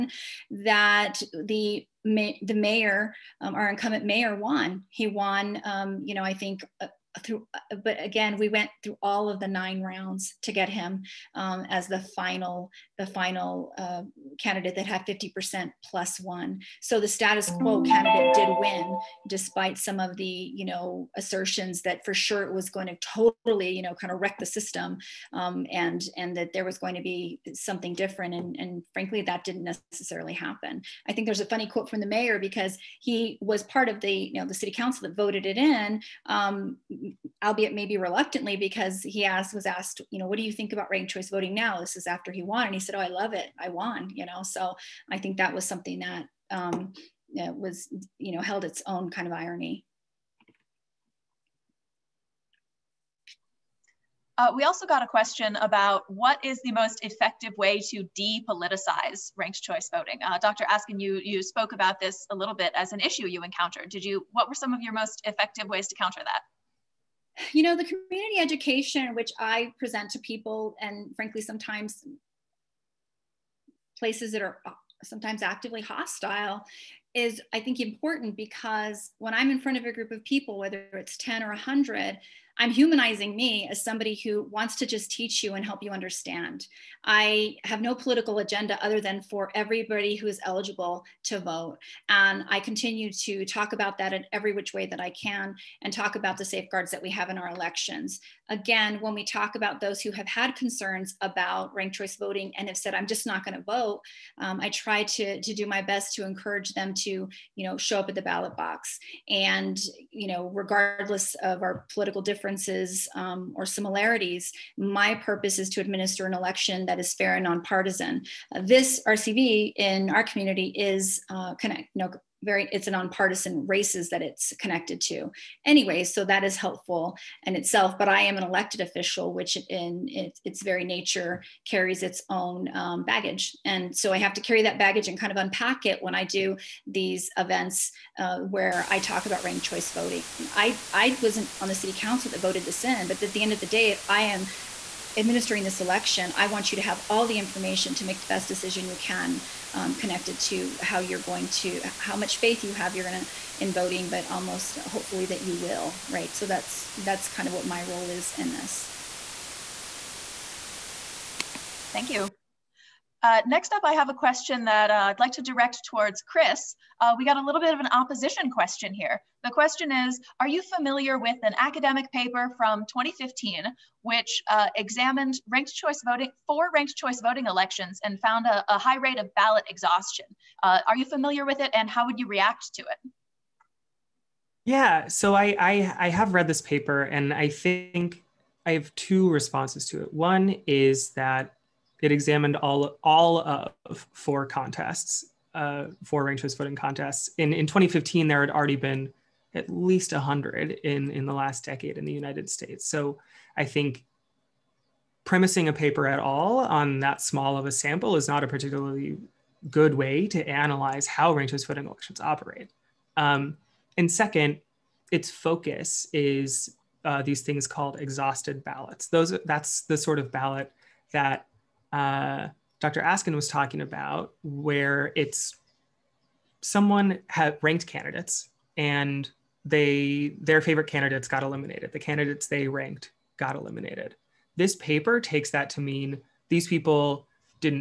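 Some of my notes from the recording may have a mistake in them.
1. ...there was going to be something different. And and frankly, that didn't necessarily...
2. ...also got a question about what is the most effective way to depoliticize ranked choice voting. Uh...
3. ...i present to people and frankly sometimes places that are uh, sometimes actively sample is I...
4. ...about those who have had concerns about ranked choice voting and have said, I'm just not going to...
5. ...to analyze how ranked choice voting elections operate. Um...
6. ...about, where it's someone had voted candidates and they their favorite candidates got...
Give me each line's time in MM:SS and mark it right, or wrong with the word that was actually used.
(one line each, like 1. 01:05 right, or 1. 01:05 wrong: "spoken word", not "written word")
1. 00:26 right
2. 00:54 right
3. 01:09 wrong: "hostile", not "sample"
4. 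01:39 right
5. 03:30 right
6. 03:43 wrong: "ranked", not "voted".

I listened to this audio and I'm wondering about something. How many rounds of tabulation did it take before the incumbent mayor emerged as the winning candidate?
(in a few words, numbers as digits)
9.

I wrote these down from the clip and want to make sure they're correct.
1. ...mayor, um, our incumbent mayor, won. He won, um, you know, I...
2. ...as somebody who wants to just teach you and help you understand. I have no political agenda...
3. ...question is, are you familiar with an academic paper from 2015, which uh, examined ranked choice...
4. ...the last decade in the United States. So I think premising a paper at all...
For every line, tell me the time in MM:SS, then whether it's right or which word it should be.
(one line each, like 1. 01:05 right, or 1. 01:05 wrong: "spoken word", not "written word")
1. 00:02 right
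2. 01:23 right
3. 02:49 right
4. 03:21 right.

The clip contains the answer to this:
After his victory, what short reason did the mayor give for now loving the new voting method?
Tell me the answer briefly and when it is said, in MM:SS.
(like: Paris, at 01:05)
I won, at 00:43.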